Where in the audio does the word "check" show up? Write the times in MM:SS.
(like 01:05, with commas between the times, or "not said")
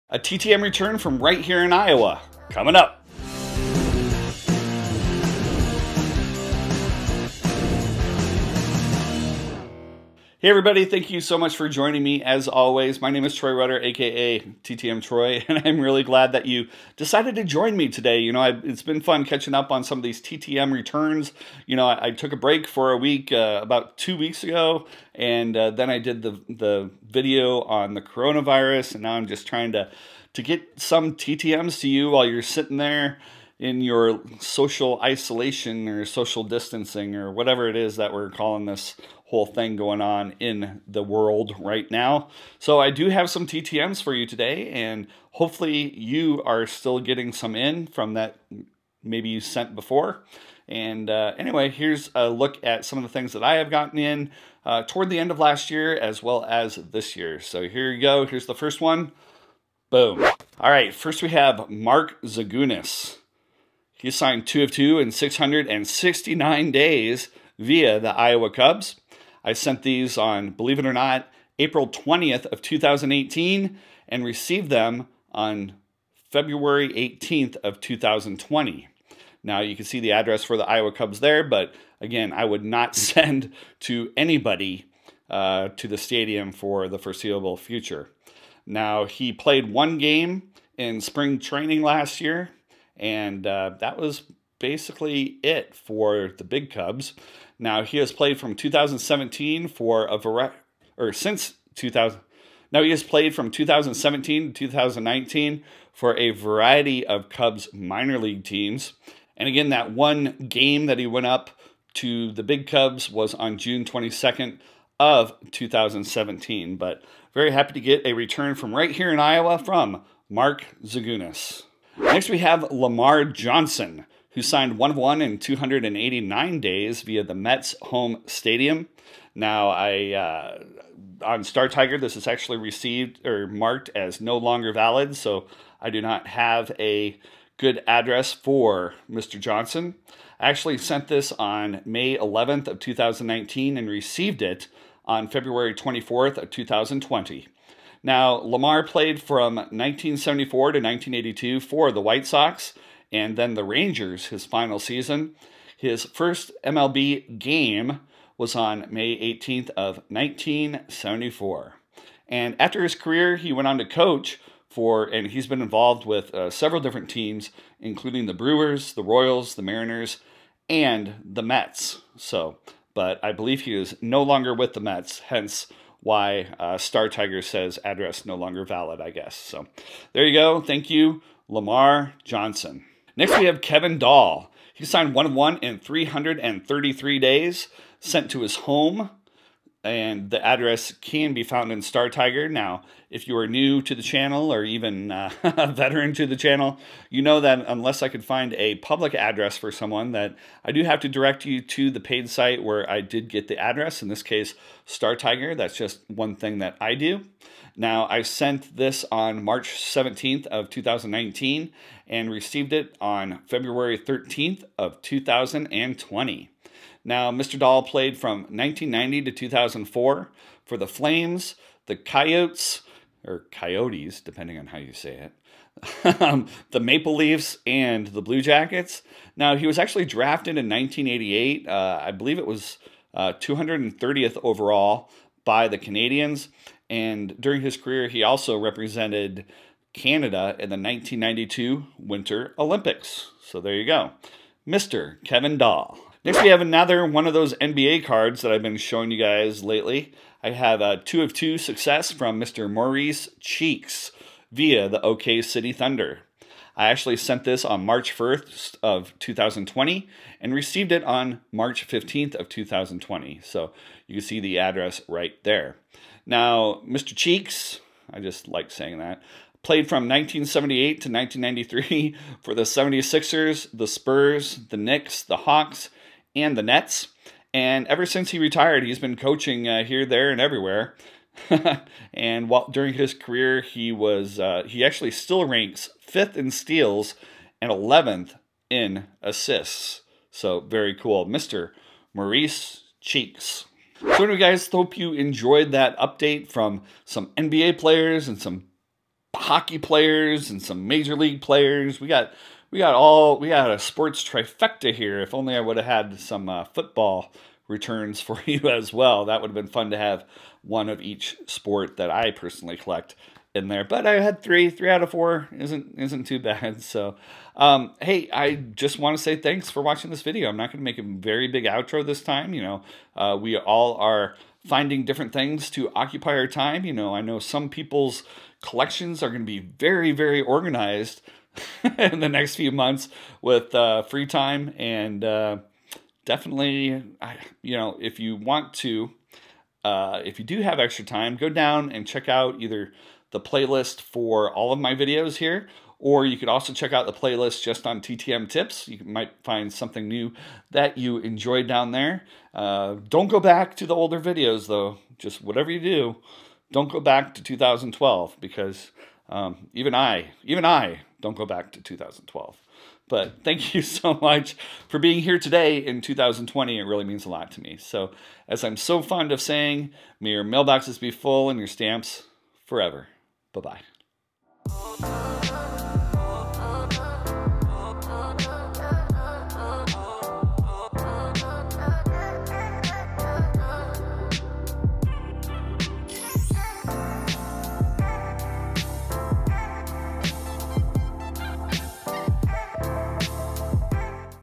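05:42, 05:46.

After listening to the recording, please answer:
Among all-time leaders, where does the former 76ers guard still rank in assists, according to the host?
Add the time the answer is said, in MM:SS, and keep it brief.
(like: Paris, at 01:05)
Eleventh, at 04:47.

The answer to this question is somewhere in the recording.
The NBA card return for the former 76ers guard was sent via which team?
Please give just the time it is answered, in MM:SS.
04:15.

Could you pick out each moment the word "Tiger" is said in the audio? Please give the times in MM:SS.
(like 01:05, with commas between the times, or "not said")
02:11, 02:57, 03:12, 03:25.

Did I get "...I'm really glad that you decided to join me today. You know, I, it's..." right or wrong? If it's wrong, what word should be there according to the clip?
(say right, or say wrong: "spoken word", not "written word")
right.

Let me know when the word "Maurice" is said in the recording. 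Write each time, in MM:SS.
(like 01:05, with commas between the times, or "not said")
04:12, 04:52.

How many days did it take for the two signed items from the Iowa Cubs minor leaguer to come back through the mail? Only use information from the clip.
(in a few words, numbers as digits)
669.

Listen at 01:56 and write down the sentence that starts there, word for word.
But very happy to get a return from right here in Iowa from Mark Zagunis.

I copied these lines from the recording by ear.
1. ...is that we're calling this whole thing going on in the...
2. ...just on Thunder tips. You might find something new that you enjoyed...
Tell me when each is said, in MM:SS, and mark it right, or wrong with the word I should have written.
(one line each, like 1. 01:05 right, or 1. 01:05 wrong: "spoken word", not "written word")
1. 00:37 right
2. 05:47 wrong: "TTM", not "Thunder".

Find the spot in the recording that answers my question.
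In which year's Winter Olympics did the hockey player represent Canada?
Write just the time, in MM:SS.
04:00.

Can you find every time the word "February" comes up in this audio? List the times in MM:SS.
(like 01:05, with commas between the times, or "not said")
01:16, 02:25, 03:33.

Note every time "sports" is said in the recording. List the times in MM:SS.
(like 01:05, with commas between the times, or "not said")
05:03, 05:11.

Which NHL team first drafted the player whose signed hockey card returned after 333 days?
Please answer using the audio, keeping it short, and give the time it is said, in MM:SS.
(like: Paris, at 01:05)
Canadiens, at 03:55.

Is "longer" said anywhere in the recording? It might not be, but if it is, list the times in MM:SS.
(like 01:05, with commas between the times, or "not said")
02:14, 02:54, 02:58.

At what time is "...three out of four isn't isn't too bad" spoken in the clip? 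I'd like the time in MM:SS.
05:14.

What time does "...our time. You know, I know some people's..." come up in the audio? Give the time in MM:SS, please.
05:26.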